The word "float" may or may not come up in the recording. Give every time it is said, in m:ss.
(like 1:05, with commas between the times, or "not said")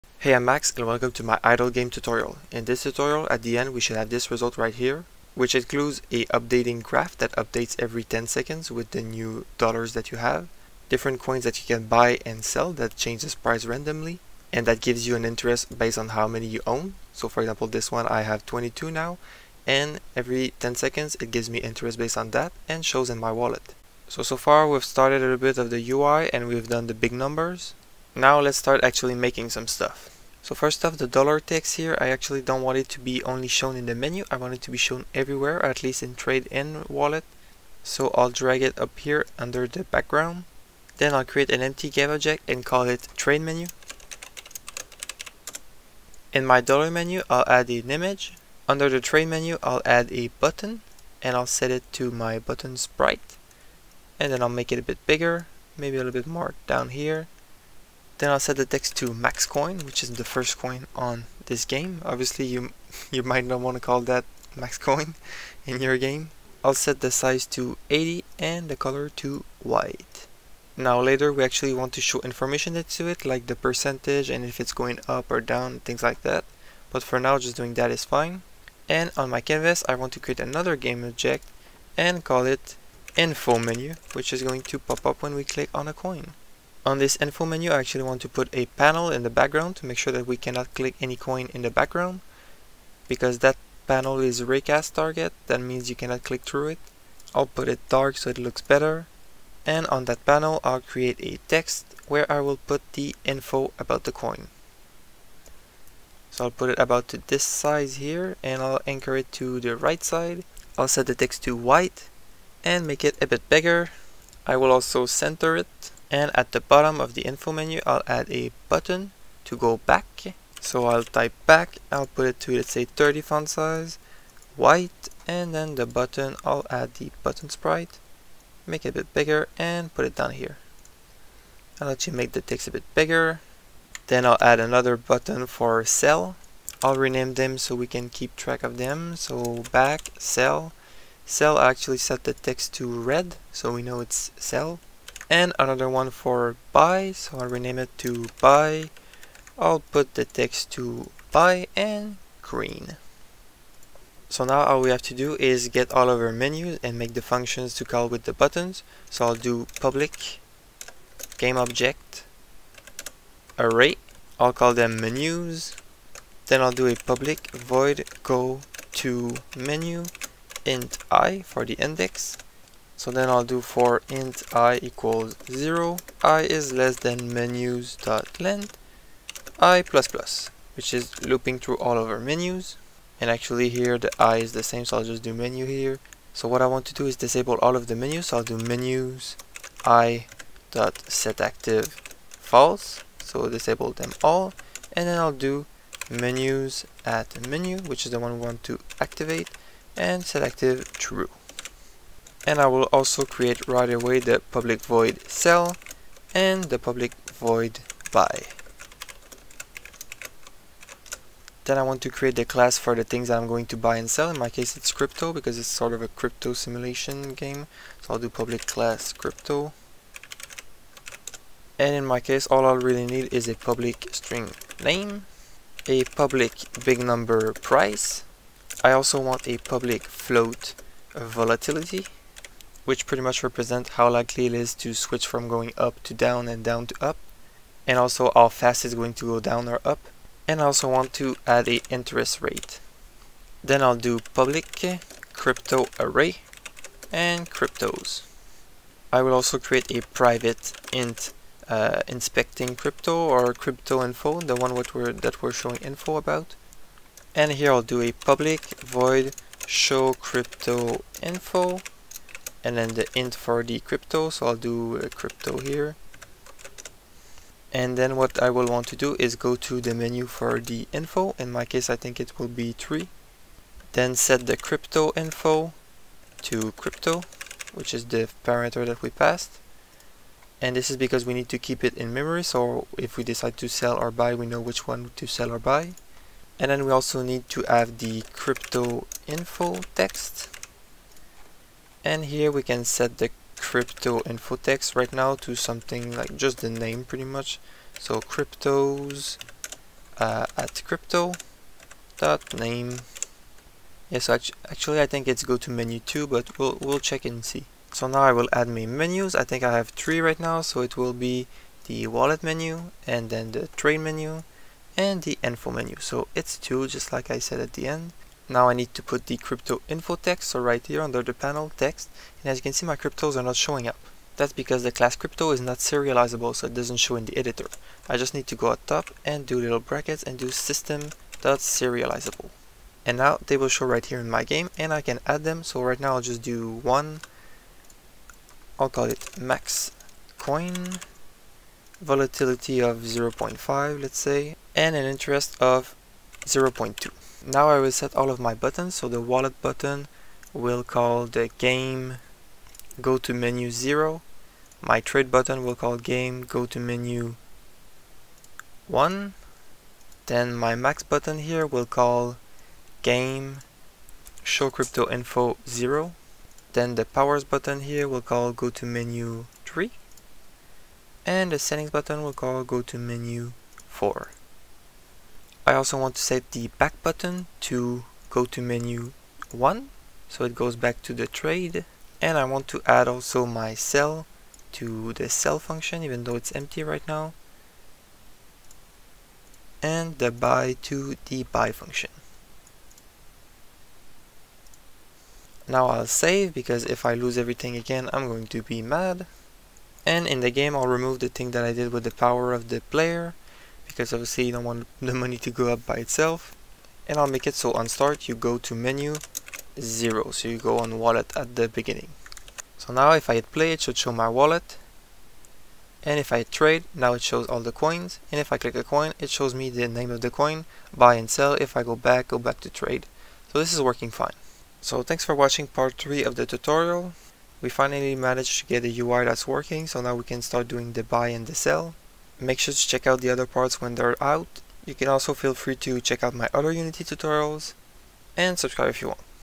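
3:50.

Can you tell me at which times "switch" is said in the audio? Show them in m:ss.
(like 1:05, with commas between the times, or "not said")
3:54.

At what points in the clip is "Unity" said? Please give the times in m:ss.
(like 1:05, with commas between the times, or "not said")
7:16.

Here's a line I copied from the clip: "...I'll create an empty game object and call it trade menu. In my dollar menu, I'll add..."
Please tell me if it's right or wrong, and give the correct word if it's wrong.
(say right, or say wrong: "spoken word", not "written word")
right.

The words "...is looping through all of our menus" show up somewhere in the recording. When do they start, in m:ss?
3:00.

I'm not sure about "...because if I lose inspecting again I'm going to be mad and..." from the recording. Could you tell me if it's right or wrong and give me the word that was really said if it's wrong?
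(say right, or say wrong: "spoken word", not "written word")
wrong: "everything", not "inspecting".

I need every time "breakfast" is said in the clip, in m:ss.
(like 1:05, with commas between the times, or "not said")
not said.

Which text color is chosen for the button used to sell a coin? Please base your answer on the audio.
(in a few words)
red.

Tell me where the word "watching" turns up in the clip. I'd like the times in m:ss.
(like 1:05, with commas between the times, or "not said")
7:05.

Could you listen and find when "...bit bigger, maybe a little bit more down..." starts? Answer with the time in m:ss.
0:54.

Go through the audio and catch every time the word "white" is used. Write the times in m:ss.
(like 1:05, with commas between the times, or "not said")
1:09, 1:51, 2:04.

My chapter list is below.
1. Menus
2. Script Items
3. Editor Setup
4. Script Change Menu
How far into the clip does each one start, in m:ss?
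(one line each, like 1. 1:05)
1. 0:30
2. 3:40
3. 5:08
4. 2:35.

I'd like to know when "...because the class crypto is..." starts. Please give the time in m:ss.
5:24.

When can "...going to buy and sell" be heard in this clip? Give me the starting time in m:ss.
3:33.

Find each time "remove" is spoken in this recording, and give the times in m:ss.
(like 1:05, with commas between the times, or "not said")
6:40.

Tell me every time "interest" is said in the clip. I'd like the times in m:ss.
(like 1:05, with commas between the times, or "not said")
0:15, 0:21, 4:01, 5:45.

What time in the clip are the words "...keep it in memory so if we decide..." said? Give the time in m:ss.
4:41.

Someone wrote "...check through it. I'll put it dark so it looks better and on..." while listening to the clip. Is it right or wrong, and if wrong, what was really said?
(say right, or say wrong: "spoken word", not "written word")
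wrong: "click", not "check".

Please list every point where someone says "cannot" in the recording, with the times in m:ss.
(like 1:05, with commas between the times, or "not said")
1:30, 1:35.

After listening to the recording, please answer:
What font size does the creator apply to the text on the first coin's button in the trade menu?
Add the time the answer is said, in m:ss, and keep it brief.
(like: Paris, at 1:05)
80, at 1:07.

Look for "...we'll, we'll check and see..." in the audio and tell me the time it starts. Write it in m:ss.
5:06.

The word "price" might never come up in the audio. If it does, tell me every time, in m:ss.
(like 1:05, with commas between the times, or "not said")
0:13, 3:47.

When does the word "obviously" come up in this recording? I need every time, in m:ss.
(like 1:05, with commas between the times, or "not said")
1:02, 6:44.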